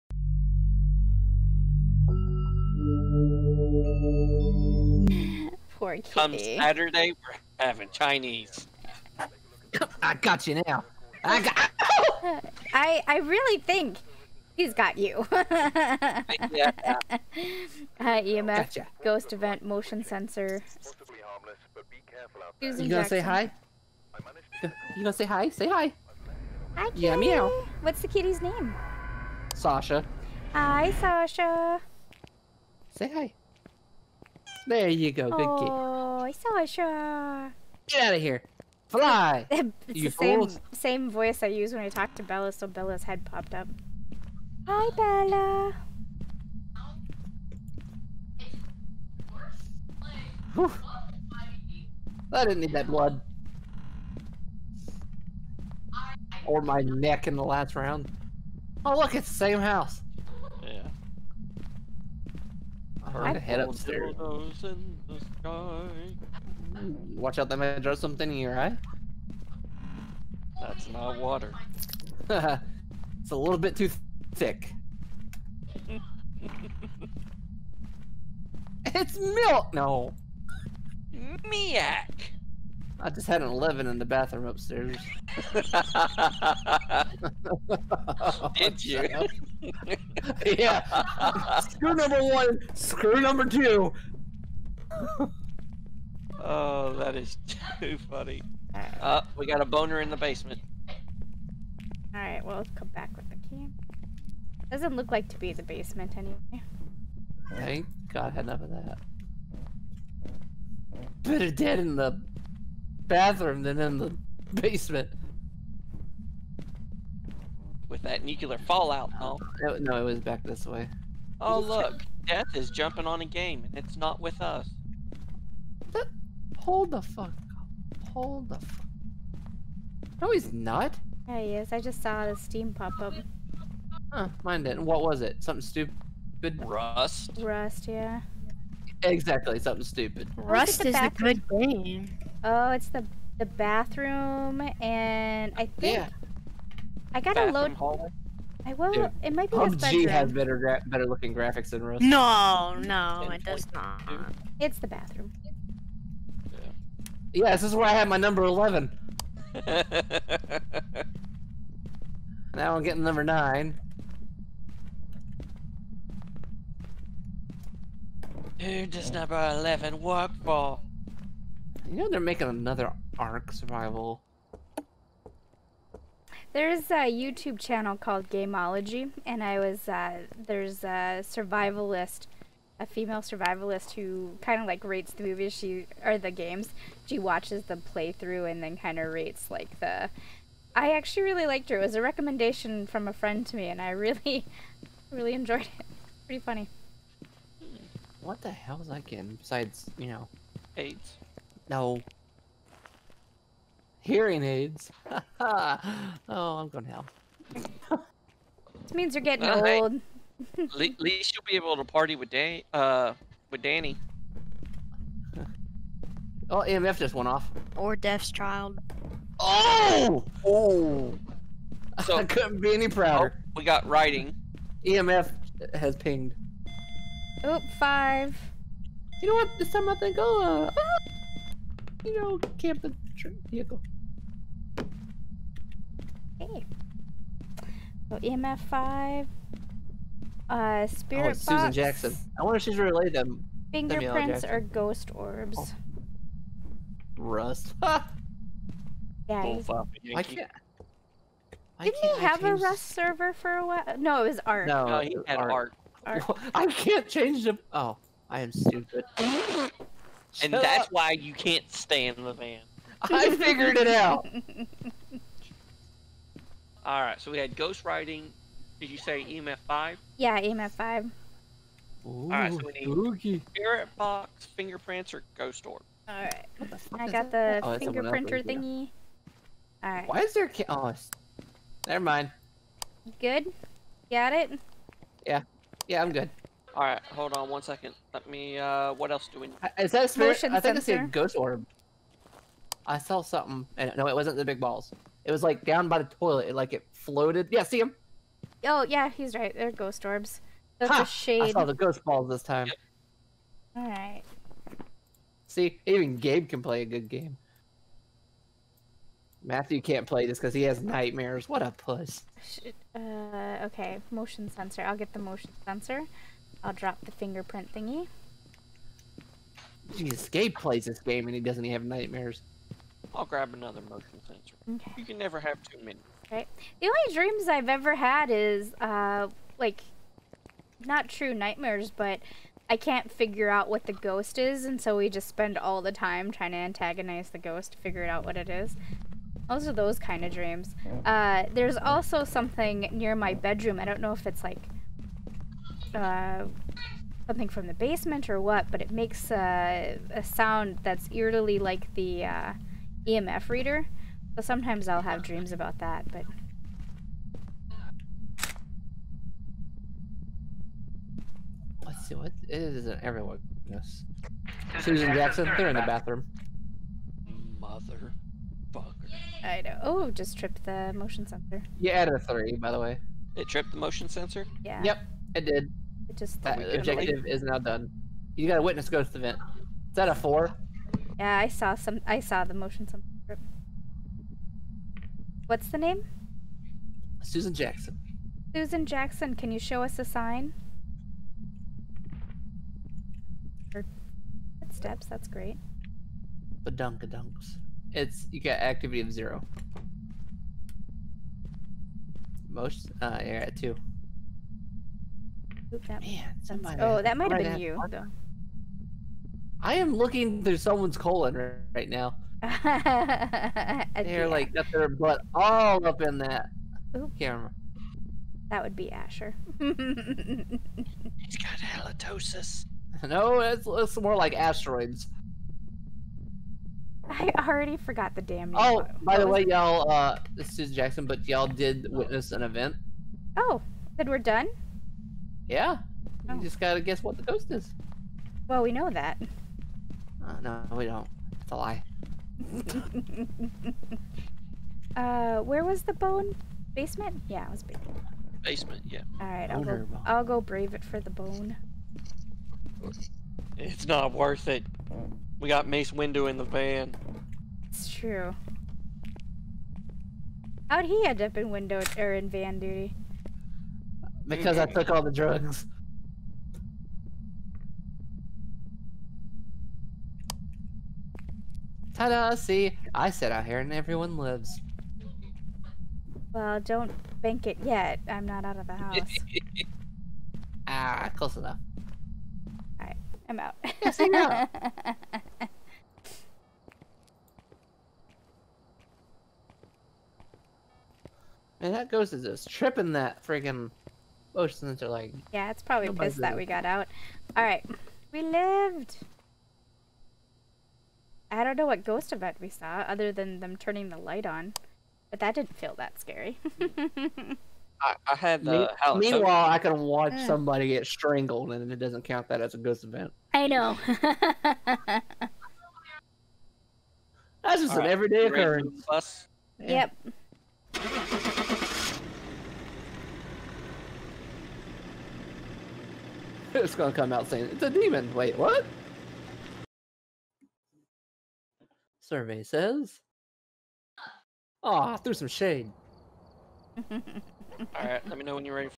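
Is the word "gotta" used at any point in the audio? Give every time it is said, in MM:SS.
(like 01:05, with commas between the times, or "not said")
02:27, 07:16.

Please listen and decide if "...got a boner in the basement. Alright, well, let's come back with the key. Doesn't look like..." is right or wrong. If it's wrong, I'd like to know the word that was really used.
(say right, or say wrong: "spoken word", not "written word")
right.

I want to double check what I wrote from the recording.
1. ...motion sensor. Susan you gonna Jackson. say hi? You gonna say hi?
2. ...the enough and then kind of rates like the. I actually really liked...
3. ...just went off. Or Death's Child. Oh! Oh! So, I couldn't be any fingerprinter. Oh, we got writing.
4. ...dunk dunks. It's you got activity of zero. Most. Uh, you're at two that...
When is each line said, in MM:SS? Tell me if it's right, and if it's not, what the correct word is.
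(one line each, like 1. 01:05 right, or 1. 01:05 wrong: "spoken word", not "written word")
1. 00:19 right
2. 03:07 wrong: "playthrough", not "enough"
3. 03:36 wrong: "prouder", not "fingerprinter"
4. 06:36 right.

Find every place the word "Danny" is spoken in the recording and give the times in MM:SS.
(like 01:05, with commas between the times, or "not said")
03:33.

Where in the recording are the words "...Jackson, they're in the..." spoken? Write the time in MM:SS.
06:05.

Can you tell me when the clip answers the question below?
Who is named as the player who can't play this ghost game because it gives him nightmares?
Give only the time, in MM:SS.
05:09.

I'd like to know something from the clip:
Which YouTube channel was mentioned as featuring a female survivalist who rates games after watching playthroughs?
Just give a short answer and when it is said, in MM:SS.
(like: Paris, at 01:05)
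Gameology, at 02:58.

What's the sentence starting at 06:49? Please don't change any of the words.
I am looking through someone's colon right now.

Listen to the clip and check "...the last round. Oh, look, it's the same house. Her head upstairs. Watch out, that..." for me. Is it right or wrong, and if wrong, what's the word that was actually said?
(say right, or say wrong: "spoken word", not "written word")
right.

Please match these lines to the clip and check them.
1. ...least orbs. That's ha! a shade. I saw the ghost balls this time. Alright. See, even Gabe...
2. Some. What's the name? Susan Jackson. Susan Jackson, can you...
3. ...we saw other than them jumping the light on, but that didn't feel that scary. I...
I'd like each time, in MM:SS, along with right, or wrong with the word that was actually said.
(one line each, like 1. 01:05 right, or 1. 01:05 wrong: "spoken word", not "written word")
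1. 04:59 wrong: "ghost", not "least"
2. 06:22 right
3. 08:22 wrong: "turning", not "jumping".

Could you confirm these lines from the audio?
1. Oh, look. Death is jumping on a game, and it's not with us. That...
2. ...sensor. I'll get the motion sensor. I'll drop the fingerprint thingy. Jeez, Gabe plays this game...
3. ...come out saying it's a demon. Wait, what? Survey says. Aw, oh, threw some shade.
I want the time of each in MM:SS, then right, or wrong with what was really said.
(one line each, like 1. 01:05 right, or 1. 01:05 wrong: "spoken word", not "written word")
1. 02:01 right
2. 05:14 right
3. 08:46 right.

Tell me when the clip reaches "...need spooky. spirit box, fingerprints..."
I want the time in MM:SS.
04:32.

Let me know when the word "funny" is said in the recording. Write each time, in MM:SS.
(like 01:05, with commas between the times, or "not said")
01:38, 03:16.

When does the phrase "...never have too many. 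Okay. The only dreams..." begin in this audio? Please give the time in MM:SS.
05:25.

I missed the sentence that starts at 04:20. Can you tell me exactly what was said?
why you can't stand the van.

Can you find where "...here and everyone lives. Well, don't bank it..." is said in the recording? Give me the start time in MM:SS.
07:53.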